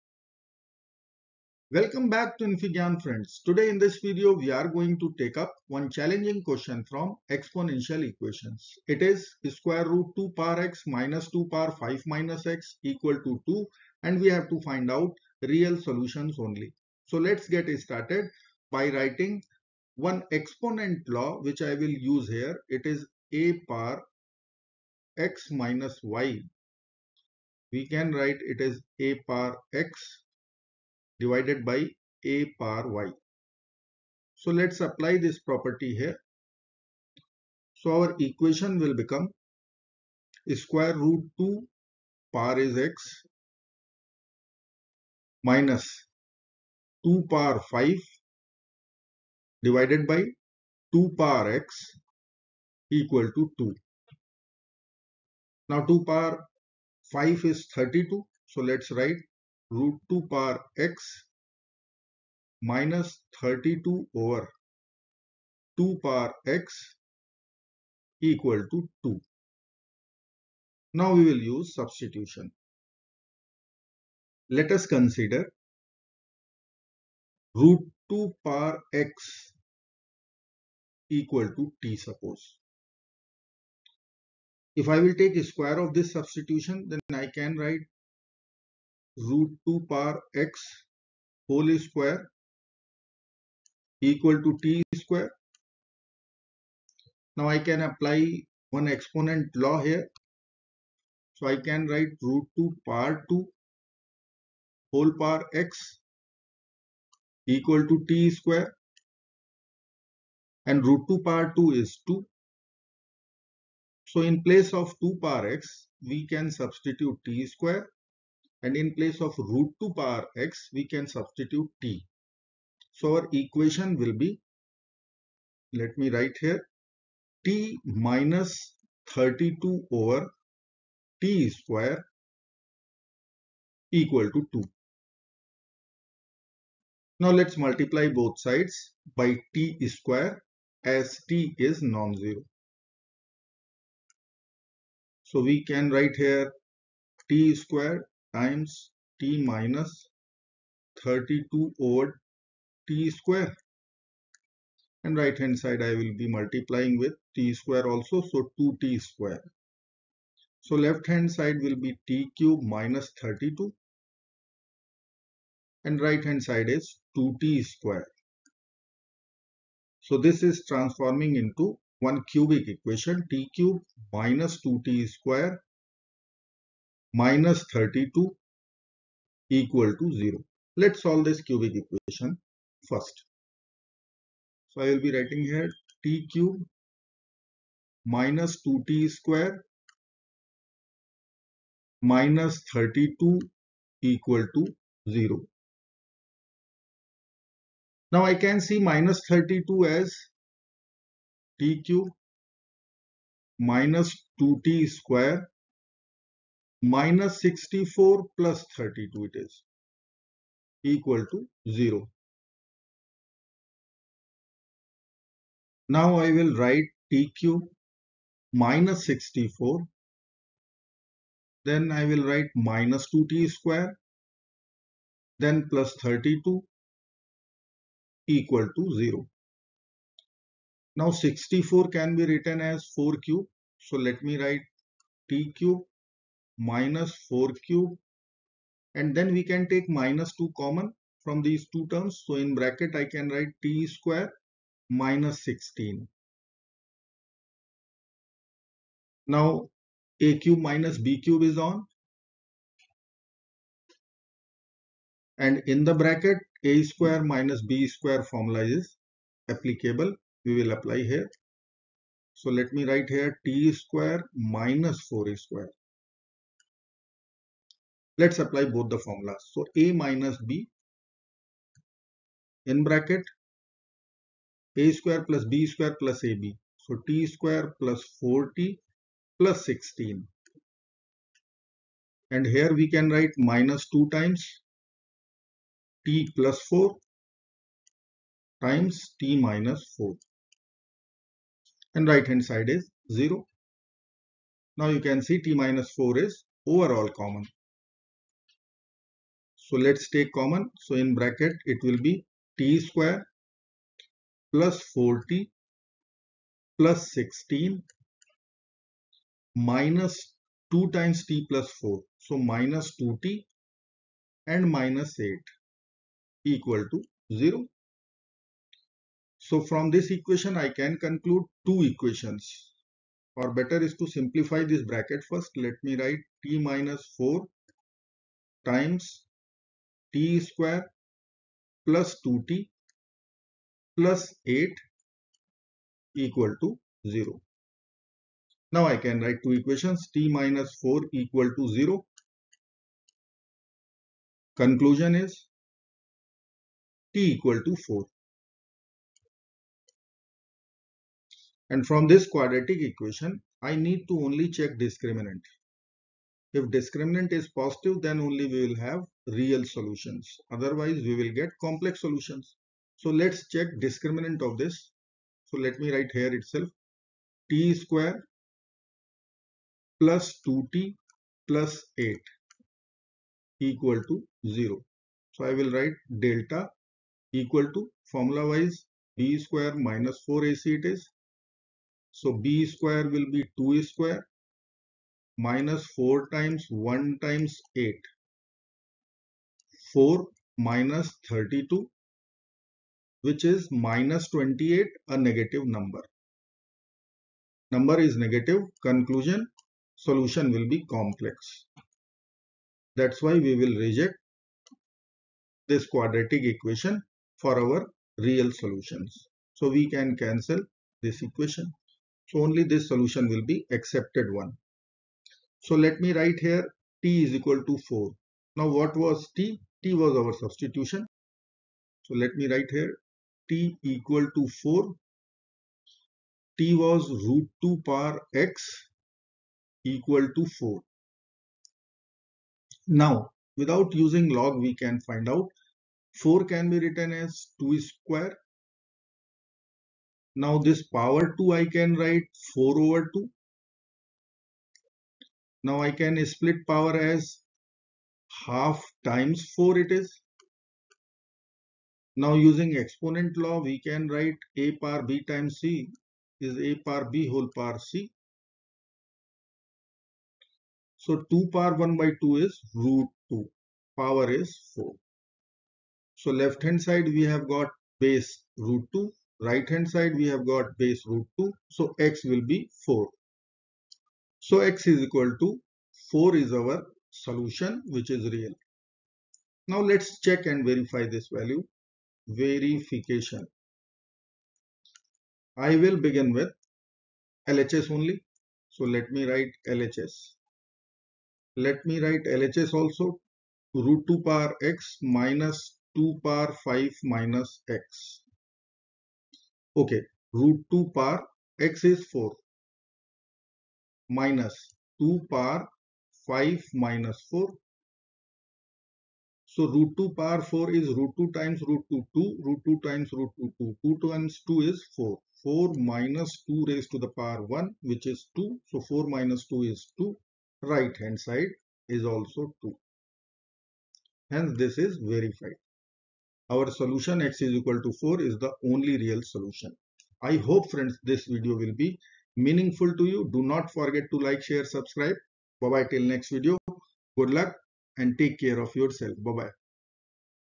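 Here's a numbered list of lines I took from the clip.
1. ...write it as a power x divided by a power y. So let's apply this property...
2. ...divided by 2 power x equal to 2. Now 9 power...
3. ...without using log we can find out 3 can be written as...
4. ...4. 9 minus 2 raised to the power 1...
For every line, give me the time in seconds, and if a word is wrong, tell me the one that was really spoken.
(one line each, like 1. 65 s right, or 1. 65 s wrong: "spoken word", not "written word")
1. 28 s right
2. 49 s wrong: "2", not "9"
3. 433 s wrong: "4", not "3"
4. 514 s wrong: "4", not "9".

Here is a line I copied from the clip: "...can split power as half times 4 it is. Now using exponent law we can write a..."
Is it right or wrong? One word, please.
right.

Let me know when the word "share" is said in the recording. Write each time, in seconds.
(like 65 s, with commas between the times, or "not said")
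534 s.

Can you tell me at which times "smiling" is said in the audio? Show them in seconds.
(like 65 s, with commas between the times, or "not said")
not said.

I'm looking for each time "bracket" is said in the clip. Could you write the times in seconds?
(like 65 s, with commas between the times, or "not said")
242 s, 255 s, 272 s, 301 s, 324 s.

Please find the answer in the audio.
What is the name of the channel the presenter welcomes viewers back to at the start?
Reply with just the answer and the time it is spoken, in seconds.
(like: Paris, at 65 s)
infyGyan, at 2 s.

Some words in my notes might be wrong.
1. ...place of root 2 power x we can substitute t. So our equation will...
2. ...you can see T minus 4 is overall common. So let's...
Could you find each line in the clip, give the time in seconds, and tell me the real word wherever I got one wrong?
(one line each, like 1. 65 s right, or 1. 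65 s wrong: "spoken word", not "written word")
1. 118 s right
2. 294 s right.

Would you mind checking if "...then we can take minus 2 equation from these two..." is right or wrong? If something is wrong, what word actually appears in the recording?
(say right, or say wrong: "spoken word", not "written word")
wrong: "common", not "equation".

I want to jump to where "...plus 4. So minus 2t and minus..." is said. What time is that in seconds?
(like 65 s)
311 s.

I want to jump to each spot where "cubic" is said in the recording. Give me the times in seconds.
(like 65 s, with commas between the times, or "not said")
172 s, 181 s.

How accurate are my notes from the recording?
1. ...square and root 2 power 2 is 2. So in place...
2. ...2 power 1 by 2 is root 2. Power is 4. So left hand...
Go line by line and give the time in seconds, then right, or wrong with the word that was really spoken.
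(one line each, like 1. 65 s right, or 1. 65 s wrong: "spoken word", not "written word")
1. 108 s right
2. 461 s right.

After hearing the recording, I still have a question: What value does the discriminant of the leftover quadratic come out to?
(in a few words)
-28.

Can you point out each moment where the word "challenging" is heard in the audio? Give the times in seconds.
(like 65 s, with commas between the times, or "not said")
5 s.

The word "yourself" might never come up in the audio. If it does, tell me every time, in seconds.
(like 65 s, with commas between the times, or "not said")
538 s.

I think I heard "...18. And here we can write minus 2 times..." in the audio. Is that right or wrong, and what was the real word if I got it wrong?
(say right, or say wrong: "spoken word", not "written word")
wrong: "16", not "18".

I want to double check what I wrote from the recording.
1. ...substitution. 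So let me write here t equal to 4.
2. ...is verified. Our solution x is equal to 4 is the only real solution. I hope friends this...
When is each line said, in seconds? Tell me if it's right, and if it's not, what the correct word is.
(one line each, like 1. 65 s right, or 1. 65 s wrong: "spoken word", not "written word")
1. 420 s right
2. 524 s right.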